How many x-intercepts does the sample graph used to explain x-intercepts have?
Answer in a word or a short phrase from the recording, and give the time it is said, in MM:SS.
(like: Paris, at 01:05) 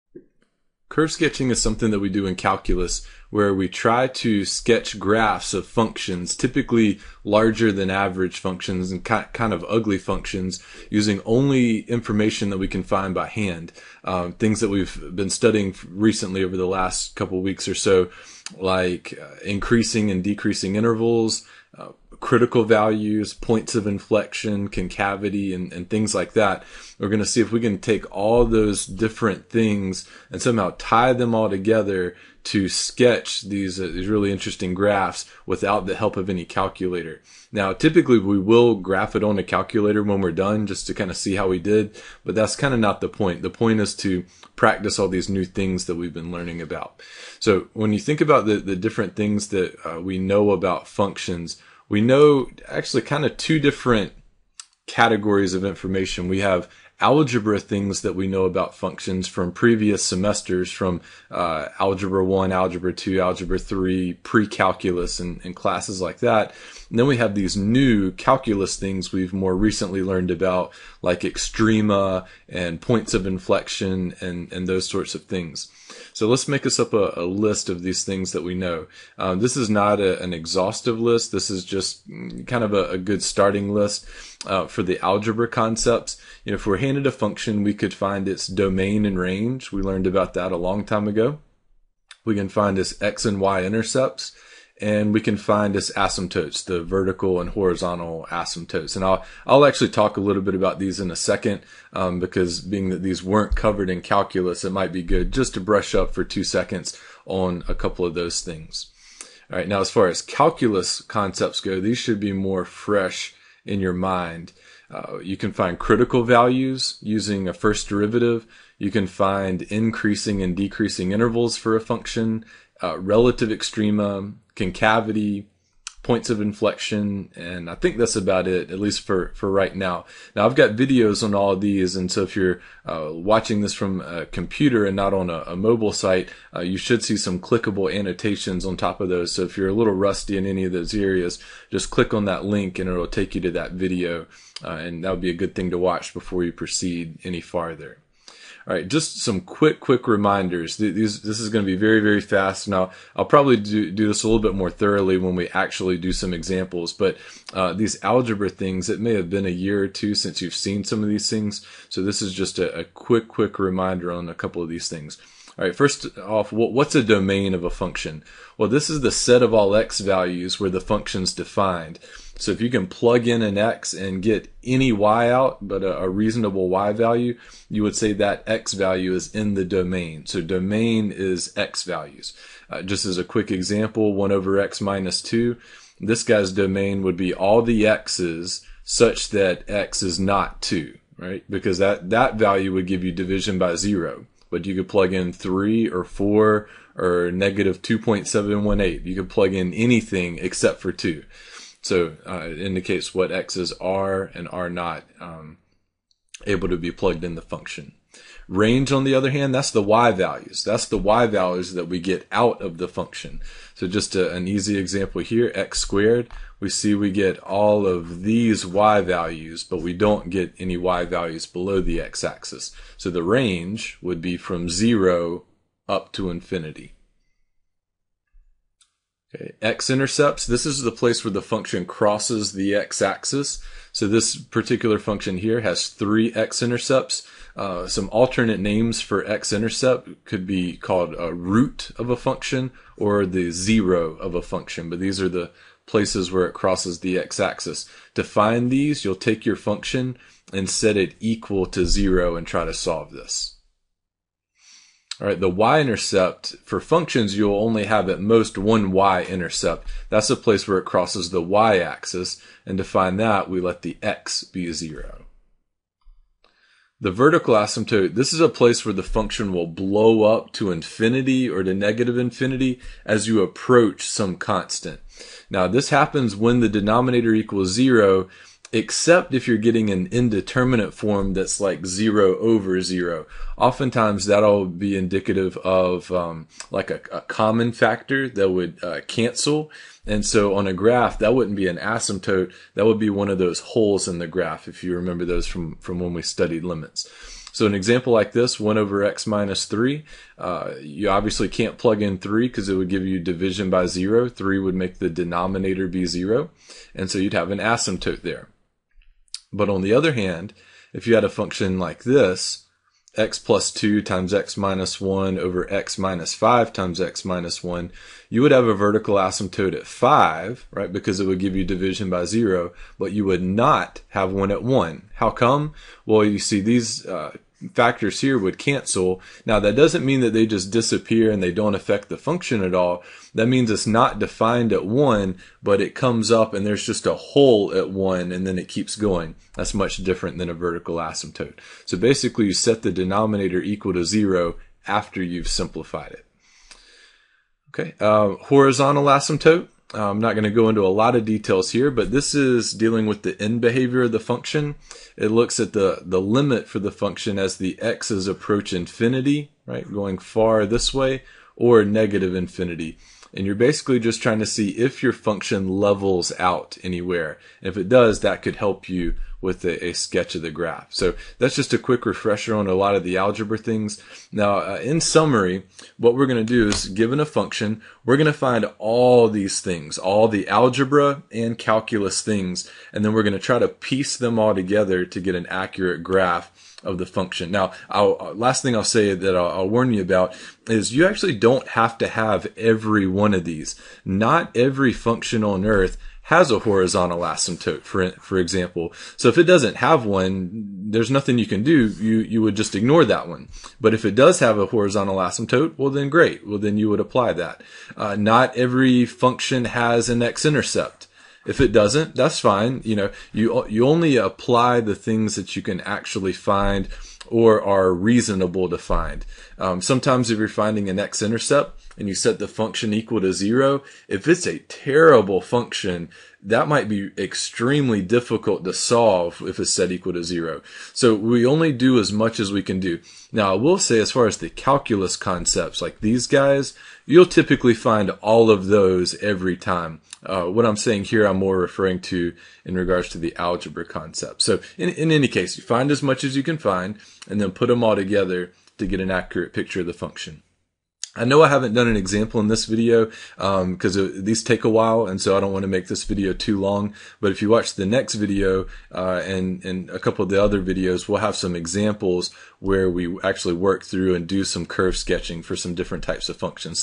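3, at 03:55.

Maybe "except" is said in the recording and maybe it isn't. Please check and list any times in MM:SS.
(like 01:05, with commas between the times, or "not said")
03:20, 04:38.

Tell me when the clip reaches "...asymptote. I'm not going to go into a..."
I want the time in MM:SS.
05:49.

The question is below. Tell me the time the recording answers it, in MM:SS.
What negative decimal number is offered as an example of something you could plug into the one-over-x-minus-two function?
03:17.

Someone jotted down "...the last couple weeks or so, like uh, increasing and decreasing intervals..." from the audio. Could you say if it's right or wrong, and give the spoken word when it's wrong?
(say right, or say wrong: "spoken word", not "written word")
right.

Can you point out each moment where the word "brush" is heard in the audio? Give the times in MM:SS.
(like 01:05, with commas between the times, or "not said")
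01:45.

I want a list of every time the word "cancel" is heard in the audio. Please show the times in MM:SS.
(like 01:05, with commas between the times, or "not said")
04:49, 05:28.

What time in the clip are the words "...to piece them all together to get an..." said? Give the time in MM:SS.
06:23.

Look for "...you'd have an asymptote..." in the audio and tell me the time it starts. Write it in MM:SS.
05:07.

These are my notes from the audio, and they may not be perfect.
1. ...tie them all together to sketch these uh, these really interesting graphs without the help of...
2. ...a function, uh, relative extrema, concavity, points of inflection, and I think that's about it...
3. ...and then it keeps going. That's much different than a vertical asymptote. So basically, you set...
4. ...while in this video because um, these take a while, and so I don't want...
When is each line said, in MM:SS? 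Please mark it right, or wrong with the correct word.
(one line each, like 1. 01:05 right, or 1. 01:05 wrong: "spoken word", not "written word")
1. 00:30 right
2. 02:01 right
3. 05:38 right
4. 07:31 wrong: "example", not "while".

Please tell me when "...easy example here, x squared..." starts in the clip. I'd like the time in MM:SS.
03:34.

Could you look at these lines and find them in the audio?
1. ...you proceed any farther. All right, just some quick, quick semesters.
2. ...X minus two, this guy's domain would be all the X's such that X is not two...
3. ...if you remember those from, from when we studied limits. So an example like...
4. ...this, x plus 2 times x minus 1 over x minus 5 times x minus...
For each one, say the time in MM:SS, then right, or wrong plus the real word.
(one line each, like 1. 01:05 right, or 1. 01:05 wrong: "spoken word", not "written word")
1. 02:26 wrong: "reminders", not "semesters"
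2. 03:04 right
3. 04:54 right
4. 05:12 right.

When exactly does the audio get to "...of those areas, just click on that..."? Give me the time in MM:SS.
02:20.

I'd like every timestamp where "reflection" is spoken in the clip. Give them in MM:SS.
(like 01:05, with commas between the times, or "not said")
not said.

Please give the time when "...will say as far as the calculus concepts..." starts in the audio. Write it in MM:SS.
07:13.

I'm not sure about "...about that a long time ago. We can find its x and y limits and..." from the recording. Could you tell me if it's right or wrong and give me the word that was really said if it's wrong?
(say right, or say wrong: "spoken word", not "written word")
wrong: "intercepts", not "limits".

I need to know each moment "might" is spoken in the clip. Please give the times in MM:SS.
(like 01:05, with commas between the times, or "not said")
01:44, 07:06.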